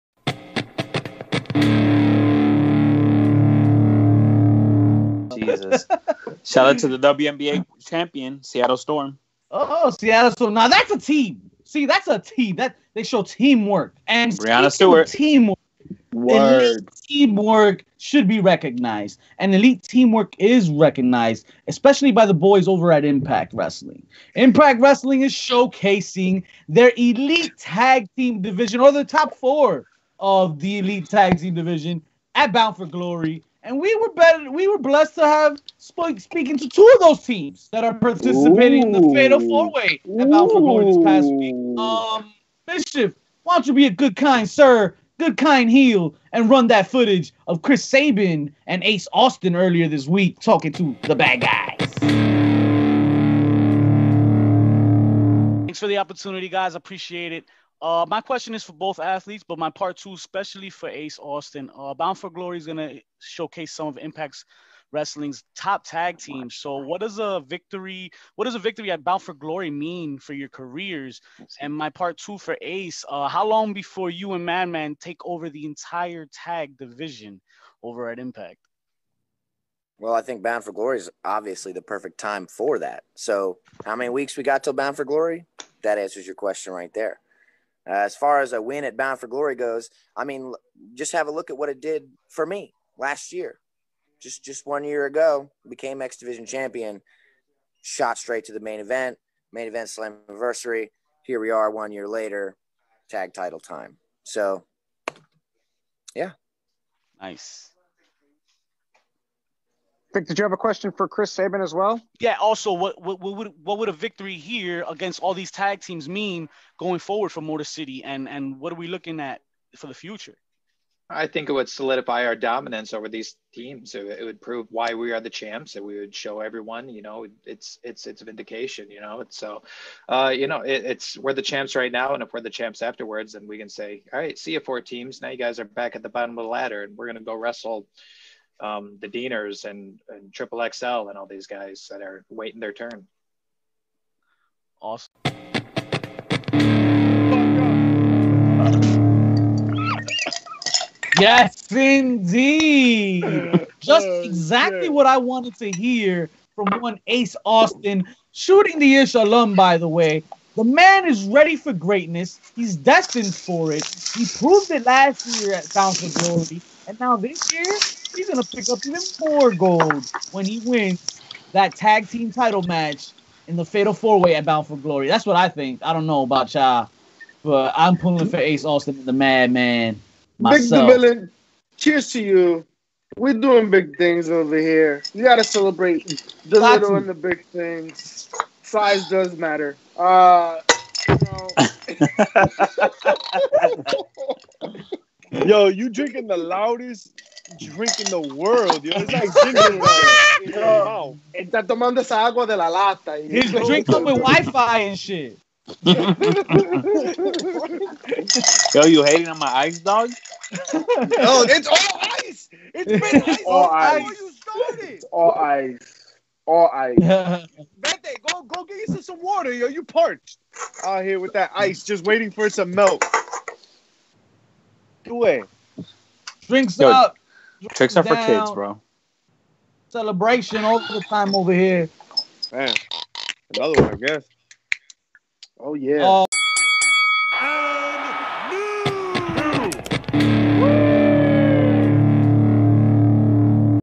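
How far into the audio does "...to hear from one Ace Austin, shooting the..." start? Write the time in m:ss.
2:35.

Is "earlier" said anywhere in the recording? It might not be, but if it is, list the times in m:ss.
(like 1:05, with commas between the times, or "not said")
0:49.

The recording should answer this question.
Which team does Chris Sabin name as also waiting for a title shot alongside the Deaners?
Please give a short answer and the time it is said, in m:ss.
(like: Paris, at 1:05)
Triple XL, at 2:20.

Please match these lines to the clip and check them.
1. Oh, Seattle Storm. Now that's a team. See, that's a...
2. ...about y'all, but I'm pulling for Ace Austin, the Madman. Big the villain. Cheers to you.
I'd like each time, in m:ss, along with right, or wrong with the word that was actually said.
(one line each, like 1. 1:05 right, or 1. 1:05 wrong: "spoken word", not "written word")
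1. 0:09 right
2. 2:56 right.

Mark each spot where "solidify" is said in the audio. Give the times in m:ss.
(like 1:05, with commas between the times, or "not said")
2:01.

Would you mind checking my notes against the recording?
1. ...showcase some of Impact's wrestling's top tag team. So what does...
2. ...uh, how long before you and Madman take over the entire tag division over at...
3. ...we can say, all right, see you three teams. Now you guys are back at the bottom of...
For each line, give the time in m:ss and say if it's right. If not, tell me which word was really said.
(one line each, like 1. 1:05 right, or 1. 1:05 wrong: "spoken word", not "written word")
1. 1:03 right
2. 1:13 right
3. 2:13 wrong: "four", not "three".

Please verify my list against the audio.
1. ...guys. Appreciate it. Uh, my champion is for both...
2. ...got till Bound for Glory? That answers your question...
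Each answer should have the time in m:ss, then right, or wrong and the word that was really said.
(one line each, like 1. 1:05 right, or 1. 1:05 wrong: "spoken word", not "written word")
1. 0:56 wrong: "question", not "champion"
2. 1:24 right.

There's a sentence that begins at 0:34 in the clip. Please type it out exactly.
We were blessed to have sp- speaking to two of those teams that are participating Ooh.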